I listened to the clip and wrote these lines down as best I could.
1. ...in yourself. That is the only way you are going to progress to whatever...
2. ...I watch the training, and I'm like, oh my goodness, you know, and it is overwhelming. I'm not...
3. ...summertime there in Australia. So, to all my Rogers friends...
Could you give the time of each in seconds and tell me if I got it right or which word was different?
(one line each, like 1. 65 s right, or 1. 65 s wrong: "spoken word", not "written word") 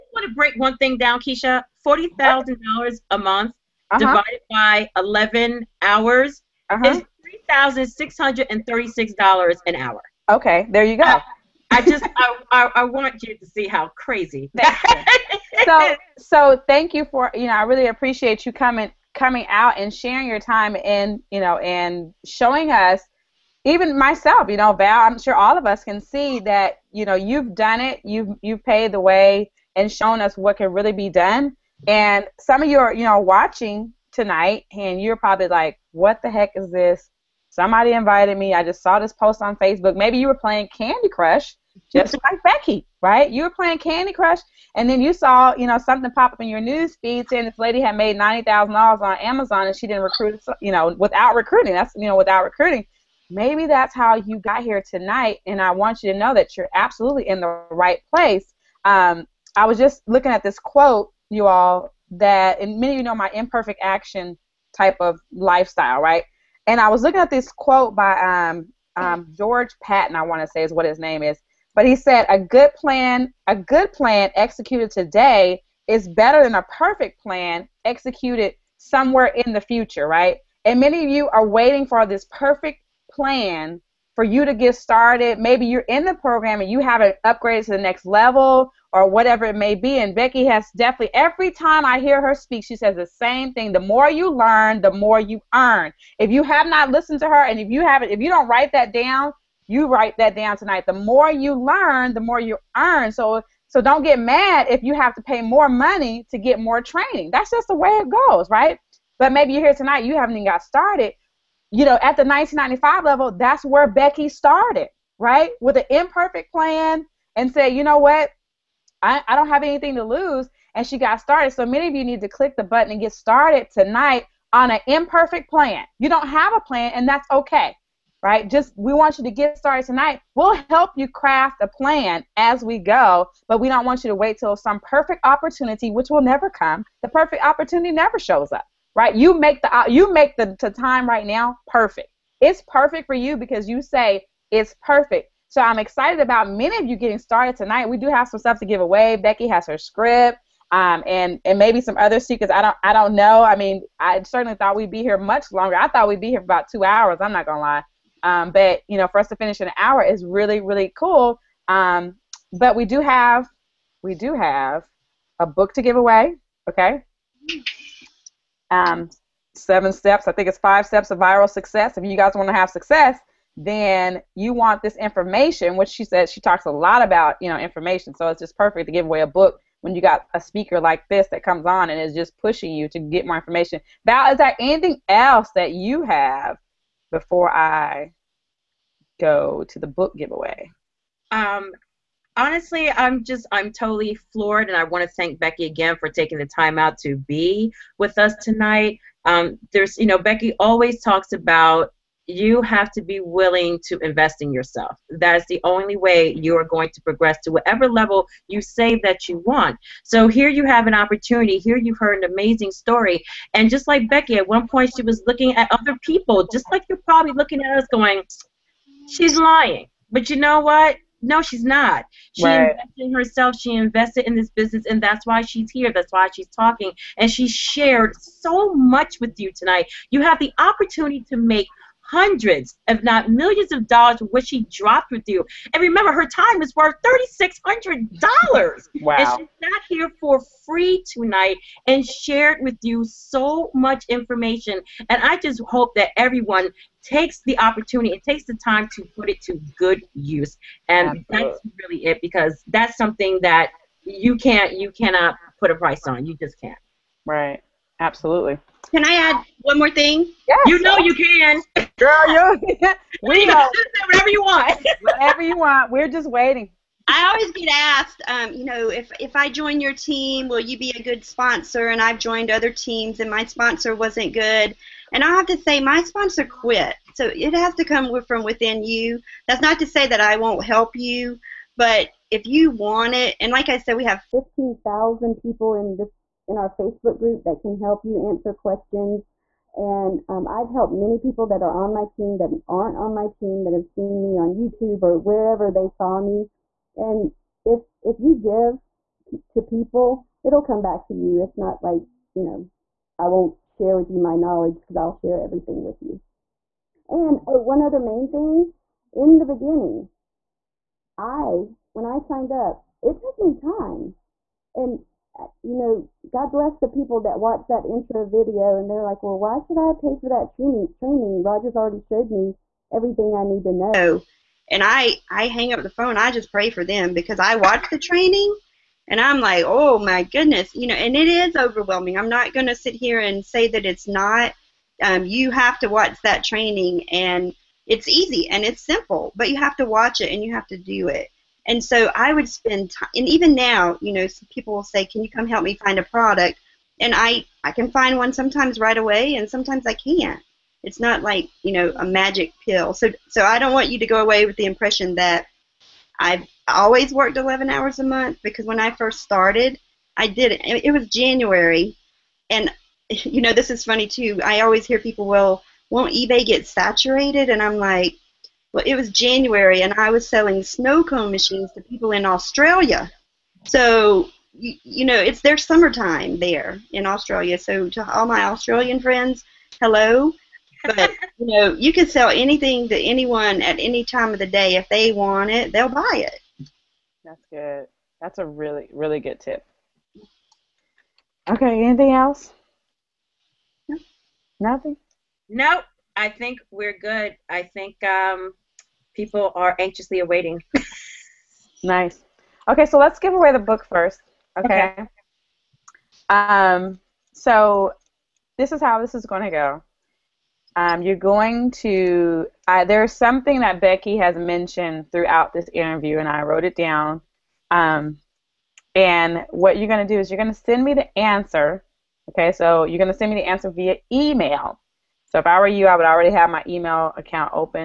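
1. 204 s right
2. 327 s right
3. 375 s wrong: "Australian", not "Rogers".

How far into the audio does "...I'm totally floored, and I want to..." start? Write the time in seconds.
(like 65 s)
193 s.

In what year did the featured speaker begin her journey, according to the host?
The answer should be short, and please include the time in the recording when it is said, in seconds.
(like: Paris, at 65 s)
1995, at 112 s.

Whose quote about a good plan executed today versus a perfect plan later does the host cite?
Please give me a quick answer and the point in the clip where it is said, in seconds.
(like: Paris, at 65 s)
George Patton, at 69 s.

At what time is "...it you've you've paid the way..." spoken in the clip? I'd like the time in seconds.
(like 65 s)
27 s.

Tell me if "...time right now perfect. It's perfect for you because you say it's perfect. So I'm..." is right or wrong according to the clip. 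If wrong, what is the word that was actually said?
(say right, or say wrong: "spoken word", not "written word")
right.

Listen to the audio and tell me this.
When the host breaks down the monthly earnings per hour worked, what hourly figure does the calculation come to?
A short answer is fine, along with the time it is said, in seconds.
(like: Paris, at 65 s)
$636, at 7 s.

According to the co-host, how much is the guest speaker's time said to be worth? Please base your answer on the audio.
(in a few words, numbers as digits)
$3,600.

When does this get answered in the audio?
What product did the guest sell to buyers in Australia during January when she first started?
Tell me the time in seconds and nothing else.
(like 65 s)
370 s.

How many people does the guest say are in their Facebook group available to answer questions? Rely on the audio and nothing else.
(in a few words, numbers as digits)
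15,000.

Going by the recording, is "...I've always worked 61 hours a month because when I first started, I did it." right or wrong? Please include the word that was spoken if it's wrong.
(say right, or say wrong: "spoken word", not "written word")
wrong: "11", not "61".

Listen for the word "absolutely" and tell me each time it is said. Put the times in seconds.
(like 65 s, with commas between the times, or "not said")
56 s, 251 s, 257 s.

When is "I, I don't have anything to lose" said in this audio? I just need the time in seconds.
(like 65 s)
119 s.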